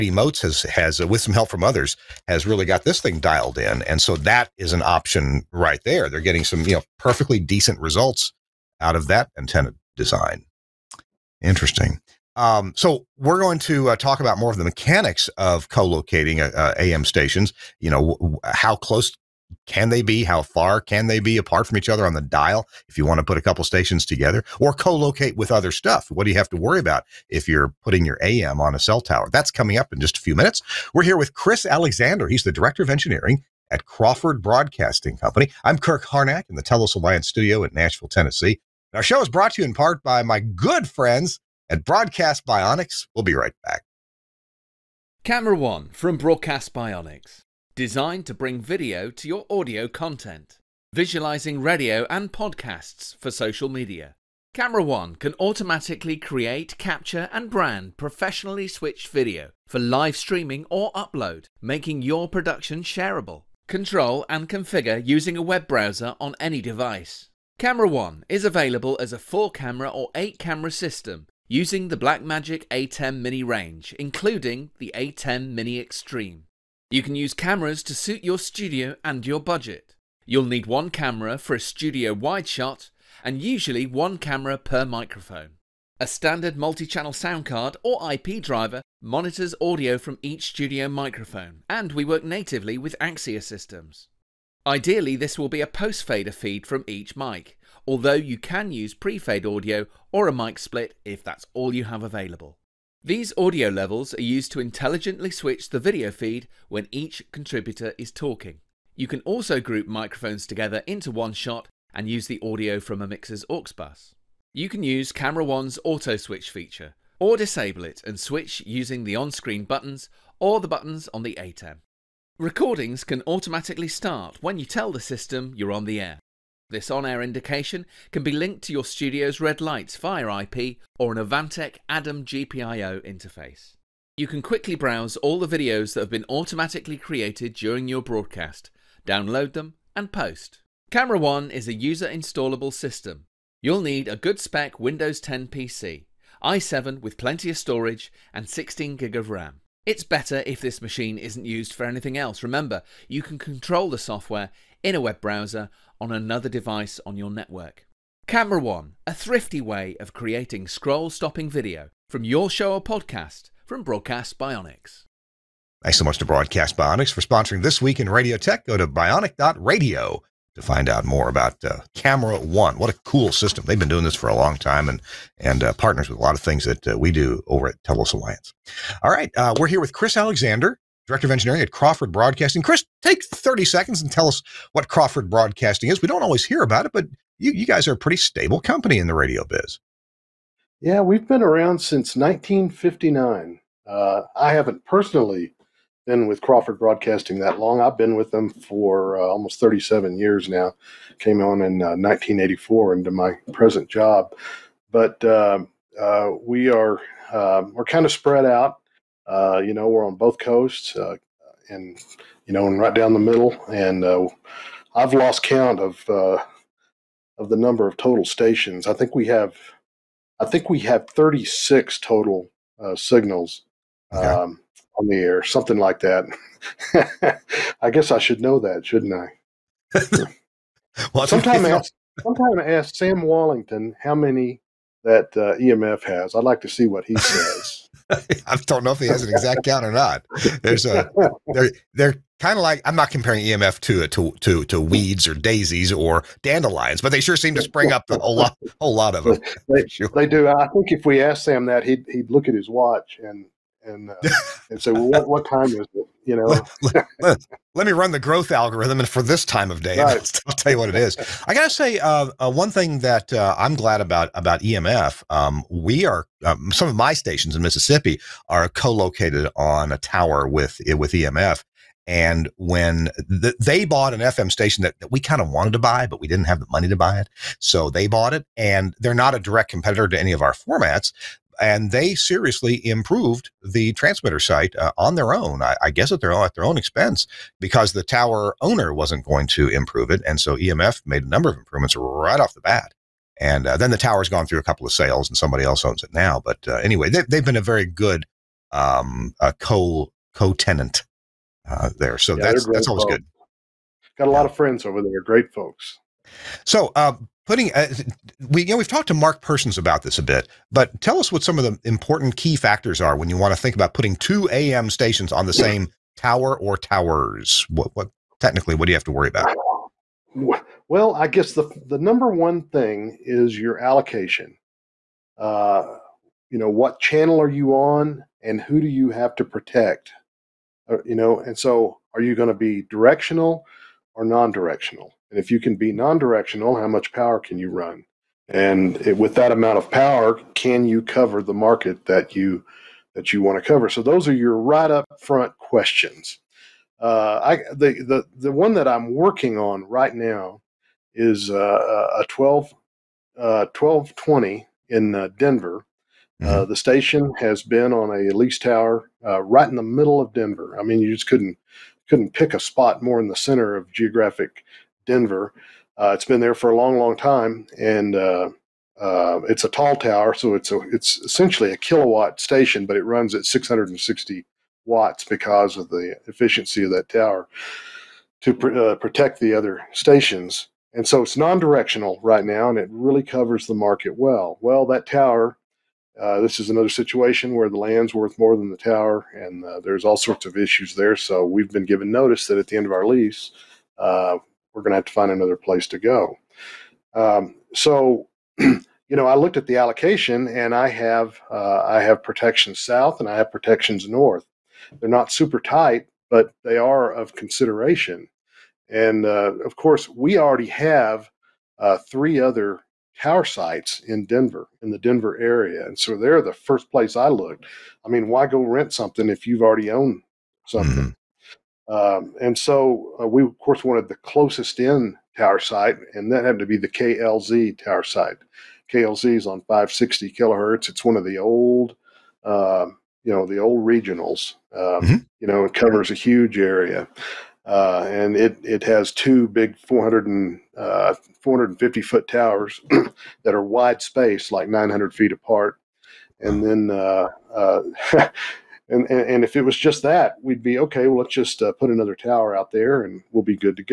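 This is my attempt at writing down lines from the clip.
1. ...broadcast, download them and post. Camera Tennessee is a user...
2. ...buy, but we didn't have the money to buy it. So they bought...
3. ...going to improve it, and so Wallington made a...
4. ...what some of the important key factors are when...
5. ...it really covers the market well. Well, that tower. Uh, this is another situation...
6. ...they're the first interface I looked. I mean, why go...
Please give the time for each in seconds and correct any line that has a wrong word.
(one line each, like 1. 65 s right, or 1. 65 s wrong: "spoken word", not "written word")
1. 138 s wrong: "One", not "Tennessee"
2. 275 s right
3. 289 s wrong: "EMF", not "Wallington"
4. 311 s right
5. 382 s right
6. 416 s wrong: "place", not "interface".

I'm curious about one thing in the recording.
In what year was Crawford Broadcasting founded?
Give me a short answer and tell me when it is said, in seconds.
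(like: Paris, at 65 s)
1959, at 191 s.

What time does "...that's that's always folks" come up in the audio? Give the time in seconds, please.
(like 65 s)
302 s.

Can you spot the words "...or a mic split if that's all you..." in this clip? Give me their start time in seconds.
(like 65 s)
100 s.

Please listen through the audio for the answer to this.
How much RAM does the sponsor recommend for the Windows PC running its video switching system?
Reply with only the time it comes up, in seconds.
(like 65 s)
148 s.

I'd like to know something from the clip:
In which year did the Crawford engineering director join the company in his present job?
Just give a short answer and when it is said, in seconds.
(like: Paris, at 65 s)
1984, at 201 s.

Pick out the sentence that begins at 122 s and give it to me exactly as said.
Recordings can automatically start when you tell the system you're on the air.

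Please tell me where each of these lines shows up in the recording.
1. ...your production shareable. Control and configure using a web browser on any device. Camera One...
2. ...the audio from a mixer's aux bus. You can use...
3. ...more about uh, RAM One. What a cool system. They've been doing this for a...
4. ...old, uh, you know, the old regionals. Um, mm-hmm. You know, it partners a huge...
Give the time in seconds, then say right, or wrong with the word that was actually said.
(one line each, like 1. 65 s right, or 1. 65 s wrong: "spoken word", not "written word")
1. 62 s right
2. 112 s right
3. 171 s wrong: "Camera", not "RAM"
4. 431 s wrong: "covers", not "partners".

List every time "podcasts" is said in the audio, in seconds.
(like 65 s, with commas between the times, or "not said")
52 s, 162 s.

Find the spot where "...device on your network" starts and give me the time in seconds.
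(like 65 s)
156 s.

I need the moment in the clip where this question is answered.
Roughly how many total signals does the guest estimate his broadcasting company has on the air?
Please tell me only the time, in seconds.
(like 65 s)
221 s.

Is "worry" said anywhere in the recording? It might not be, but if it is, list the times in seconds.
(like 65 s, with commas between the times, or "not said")
26 s, 319 s.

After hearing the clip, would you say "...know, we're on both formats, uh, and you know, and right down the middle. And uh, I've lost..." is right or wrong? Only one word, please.
wrong.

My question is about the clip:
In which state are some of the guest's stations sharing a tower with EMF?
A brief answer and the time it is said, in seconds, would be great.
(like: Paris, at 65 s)
Mississippi, at 267 s.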